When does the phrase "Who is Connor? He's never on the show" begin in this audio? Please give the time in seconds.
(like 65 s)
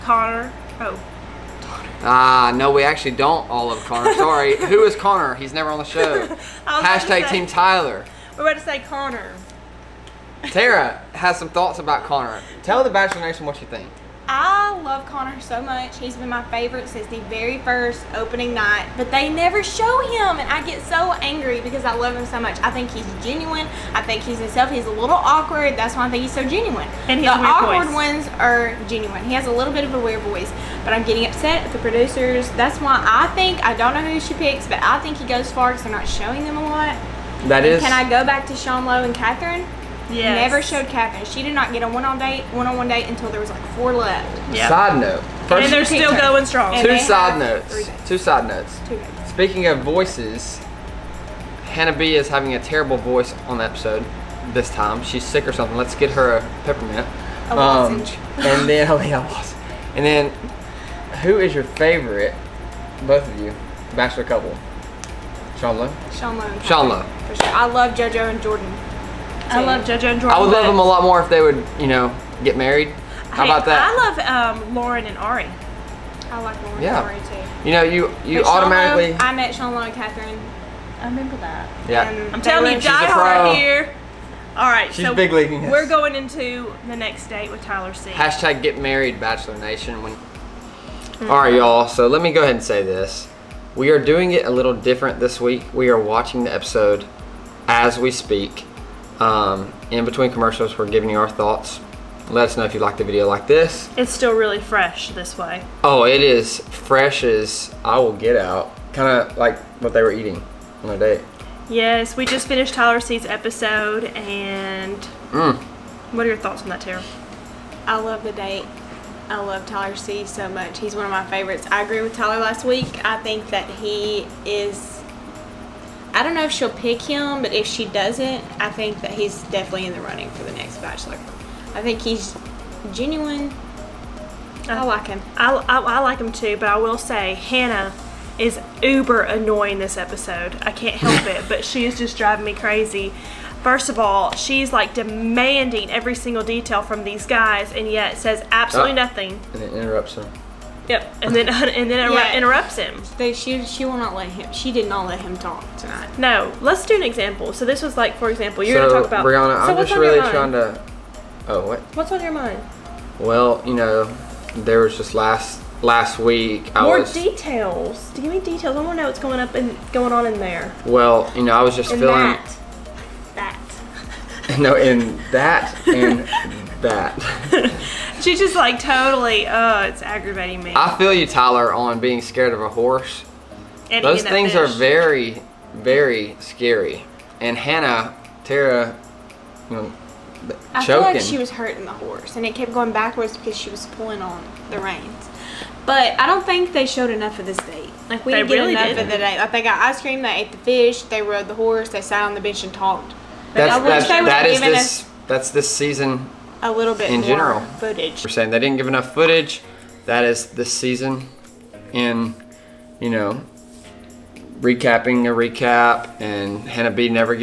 4 s.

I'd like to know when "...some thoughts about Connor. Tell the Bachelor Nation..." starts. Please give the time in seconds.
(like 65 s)
11 s.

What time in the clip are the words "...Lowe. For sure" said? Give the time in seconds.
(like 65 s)
66 s.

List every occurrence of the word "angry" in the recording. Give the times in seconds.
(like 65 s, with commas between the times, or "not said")
21 s.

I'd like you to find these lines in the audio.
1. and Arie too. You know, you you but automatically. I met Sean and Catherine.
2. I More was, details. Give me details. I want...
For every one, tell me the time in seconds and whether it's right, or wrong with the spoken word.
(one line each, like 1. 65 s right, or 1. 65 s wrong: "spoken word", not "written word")
1. 77 s right
2. 166 s right.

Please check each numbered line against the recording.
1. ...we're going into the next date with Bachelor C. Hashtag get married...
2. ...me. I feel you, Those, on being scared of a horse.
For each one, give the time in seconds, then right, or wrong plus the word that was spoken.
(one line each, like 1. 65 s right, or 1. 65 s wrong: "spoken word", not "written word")
1. 85 s wrong: "Tyler", not "Bachelor"
2. 180 s wrong: "Tyler", not "Those".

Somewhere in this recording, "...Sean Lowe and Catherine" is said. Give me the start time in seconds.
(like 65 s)
38 s.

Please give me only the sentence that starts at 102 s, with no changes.
Let us know if you like the video like this.